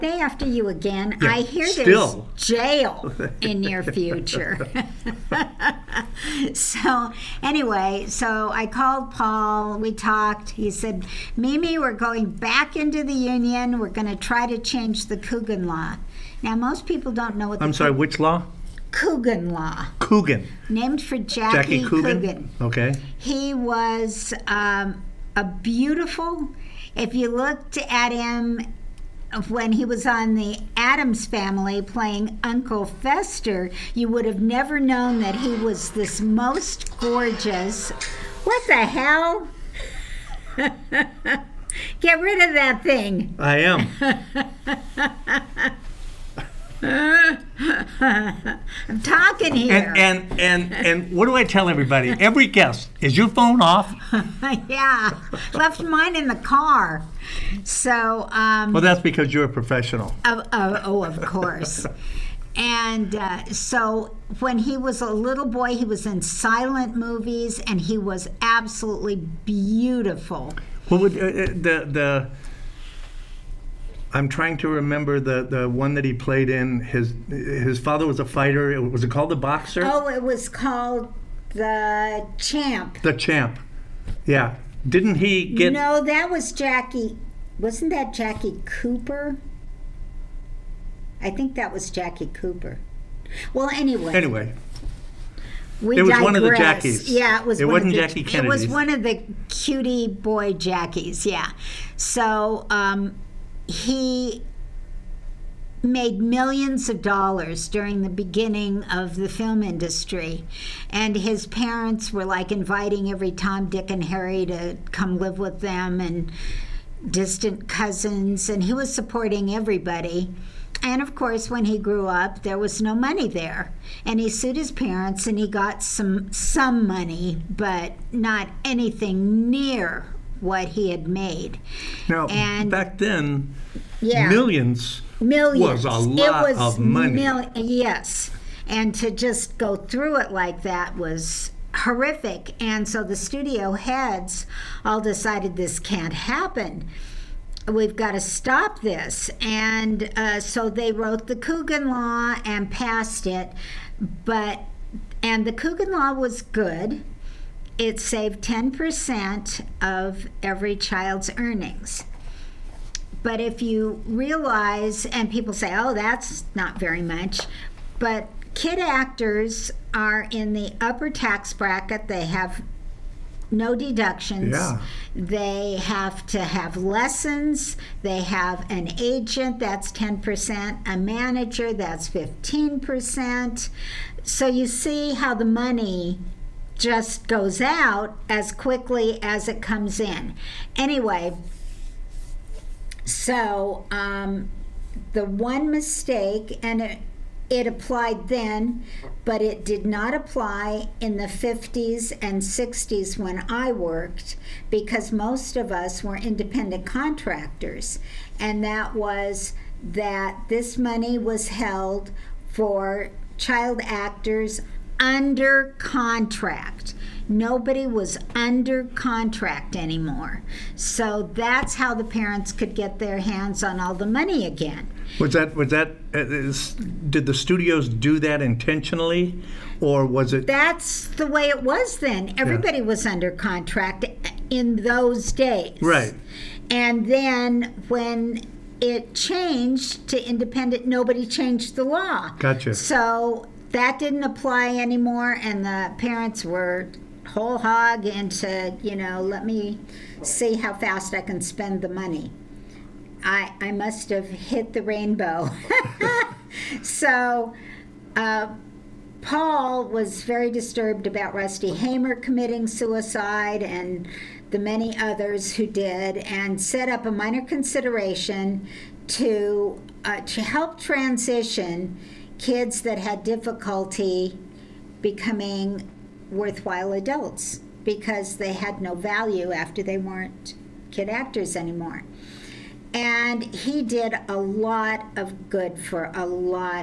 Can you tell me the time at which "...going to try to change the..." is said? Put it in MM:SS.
00:13.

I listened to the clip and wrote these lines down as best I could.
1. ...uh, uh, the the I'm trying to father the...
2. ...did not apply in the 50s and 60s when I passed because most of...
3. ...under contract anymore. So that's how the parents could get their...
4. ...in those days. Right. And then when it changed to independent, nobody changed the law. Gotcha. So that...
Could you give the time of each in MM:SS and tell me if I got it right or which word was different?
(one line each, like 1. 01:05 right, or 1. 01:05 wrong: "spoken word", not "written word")
1. 01:11 wrong: "remember", not "father"
2. 03:19 wrong: "worked", not "passed"
3. 03:38 right
4. 03:54 right.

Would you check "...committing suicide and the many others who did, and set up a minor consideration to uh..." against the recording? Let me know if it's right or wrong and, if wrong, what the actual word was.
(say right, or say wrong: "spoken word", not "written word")
right.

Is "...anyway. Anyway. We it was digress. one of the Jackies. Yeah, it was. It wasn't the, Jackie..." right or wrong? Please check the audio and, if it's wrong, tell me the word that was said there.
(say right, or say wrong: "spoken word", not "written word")
right.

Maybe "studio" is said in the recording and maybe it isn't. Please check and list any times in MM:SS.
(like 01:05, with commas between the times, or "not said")
02:23, 03:47.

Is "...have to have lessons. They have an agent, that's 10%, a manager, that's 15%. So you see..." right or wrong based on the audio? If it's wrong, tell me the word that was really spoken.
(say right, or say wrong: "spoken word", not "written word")
right.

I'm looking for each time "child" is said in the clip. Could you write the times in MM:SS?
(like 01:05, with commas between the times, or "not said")
02:40, 03:33.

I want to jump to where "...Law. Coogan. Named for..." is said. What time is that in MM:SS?
00:19.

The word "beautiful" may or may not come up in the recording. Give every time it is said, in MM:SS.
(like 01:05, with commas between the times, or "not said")
00:25, 01:09.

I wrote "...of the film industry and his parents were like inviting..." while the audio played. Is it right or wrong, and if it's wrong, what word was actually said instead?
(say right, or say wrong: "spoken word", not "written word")
right.